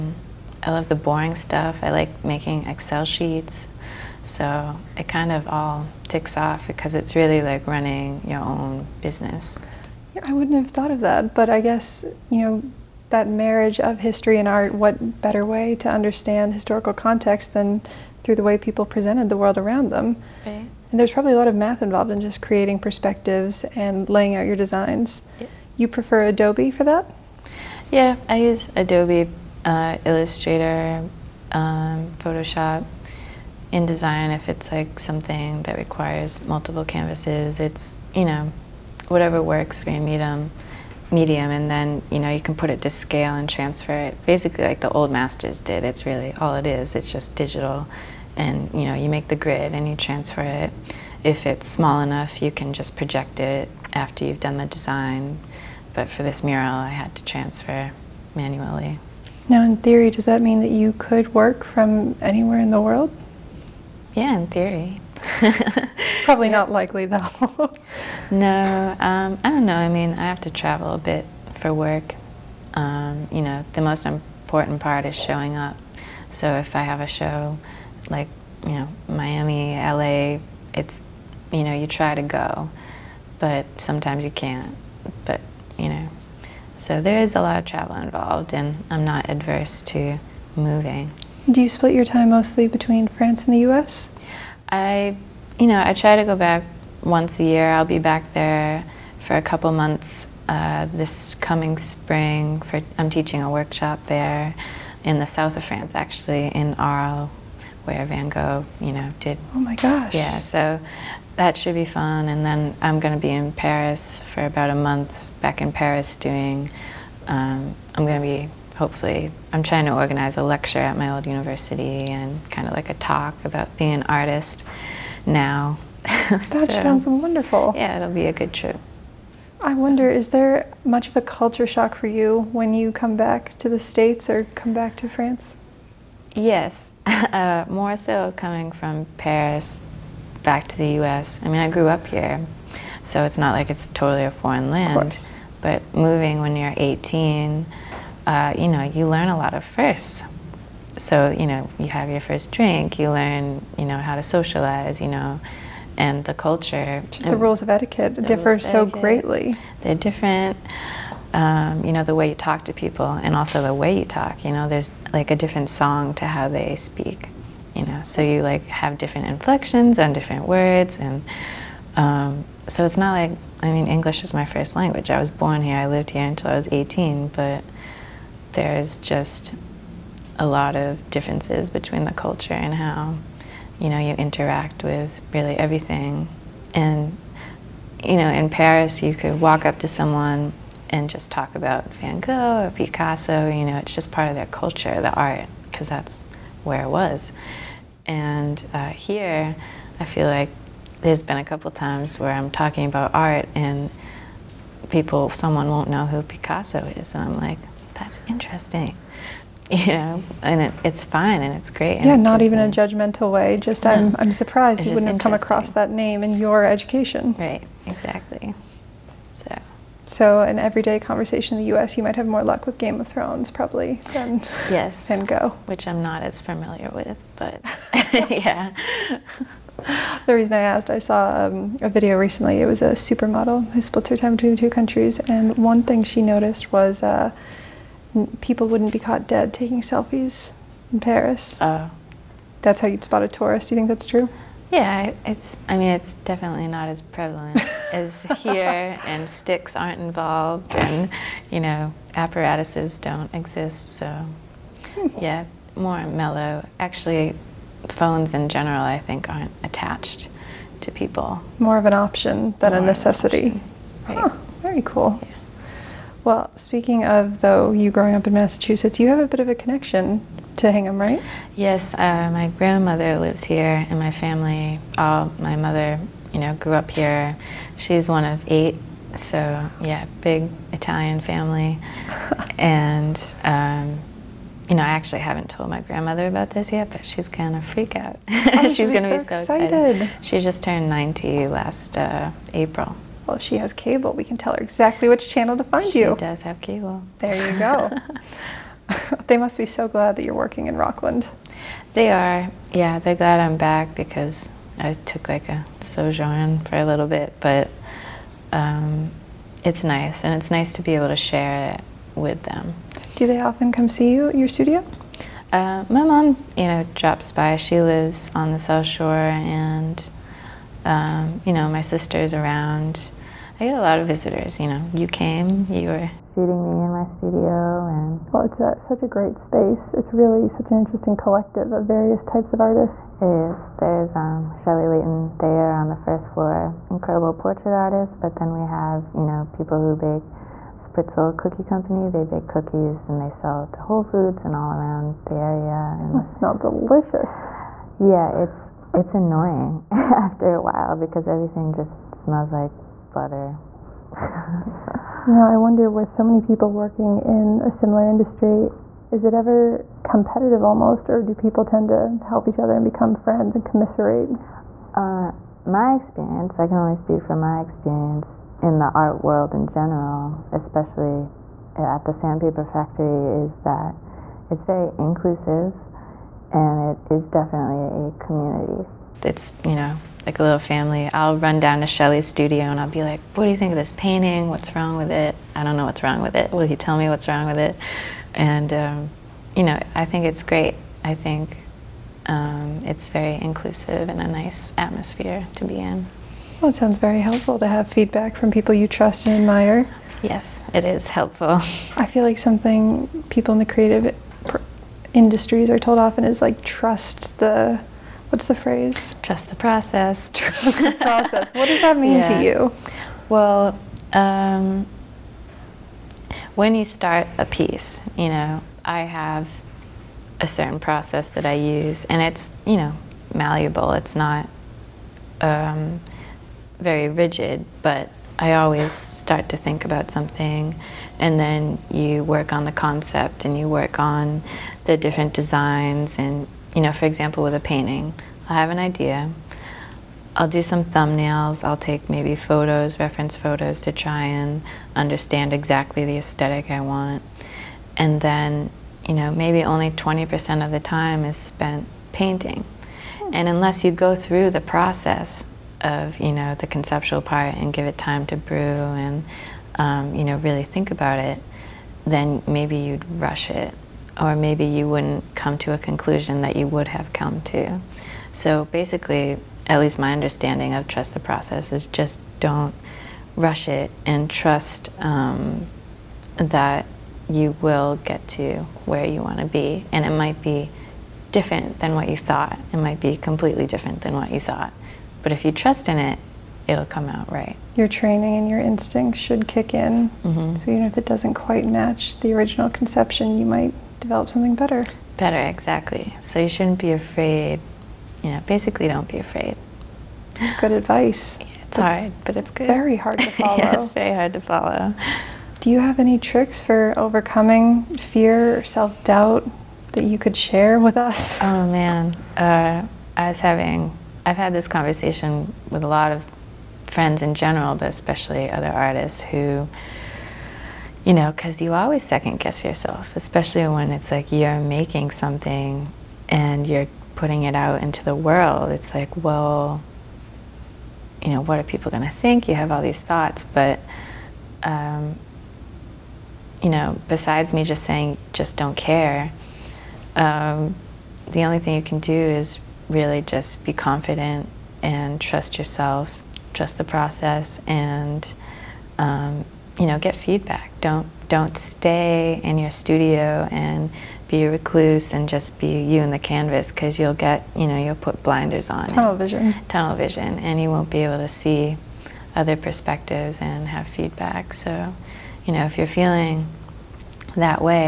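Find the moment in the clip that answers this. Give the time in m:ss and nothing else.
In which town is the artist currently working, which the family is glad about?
5:00.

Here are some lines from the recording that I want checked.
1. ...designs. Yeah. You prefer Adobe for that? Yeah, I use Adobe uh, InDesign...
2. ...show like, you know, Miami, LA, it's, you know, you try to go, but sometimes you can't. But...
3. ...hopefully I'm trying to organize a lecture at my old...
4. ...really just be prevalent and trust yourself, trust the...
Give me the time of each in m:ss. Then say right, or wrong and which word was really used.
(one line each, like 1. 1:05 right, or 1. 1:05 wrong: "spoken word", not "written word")
1. 0:24 wrong: "Illustrator", not "InDesign"
2. 1:17 right
3. 1:58 right
4. 9:02 wrong: "confident", not "prevalent".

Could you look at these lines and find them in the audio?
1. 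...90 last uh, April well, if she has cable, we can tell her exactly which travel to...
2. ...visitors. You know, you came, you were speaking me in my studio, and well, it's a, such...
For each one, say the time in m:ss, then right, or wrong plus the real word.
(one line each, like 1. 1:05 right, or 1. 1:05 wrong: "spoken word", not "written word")
1. 4:50 wrong: "channel", not "travel"
2. 5:24 wrong: "shooting", not "speaking".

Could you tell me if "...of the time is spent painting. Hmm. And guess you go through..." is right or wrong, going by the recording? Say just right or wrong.
wrong.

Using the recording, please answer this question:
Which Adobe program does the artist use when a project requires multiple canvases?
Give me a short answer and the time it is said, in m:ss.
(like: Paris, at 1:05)
InDesign, at 0:33.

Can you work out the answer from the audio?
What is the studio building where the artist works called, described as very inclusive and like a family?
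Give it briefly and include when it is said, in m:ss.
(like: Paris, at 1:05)
the sandpaper factory, at 6:12.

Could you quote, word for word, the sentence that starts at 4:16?
Actually, phones in general, I think, aren't attached to people.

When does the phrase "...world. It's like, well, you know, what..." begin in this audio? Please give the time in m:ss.
8:48.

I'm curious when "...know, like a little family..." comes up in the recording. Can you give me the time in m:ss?
6:19.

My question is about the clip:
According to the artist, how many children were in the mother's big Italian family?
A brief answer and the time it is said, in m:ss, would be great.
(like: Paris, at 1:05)
8, at 4:38.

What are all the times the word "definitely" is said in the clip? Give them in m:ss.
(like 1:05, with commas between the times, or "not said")
4:06, 6:17.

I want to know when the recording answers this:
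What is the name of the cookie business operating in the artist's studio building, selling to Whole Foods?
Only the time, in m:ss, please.
5:40.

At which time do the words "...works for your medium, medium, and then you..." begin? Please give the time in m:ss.
0:39.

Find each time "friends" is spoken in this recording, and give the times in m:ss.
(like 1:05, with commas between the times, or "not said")
6:03, 8:36.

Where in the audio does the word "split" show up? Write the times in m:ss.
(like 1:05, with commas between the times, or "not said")
1:31, 3:53.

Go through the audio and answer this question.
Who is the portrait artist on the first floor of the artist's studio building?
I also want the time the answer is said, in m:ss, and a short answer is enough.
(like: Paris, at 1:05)
Shelley Leighton, at 5:34.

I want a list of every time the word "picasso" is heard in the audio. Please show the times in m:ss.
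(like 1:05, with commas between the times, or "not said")
3:12, 3:26.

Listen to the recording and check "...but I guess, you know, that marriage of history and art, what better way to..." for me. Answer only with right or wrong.
right.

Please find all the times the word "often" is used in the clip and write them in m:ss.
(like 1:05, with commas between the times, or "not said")
5:13, 6:45.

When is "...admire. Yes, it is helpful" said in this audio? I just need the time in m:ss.
6:39.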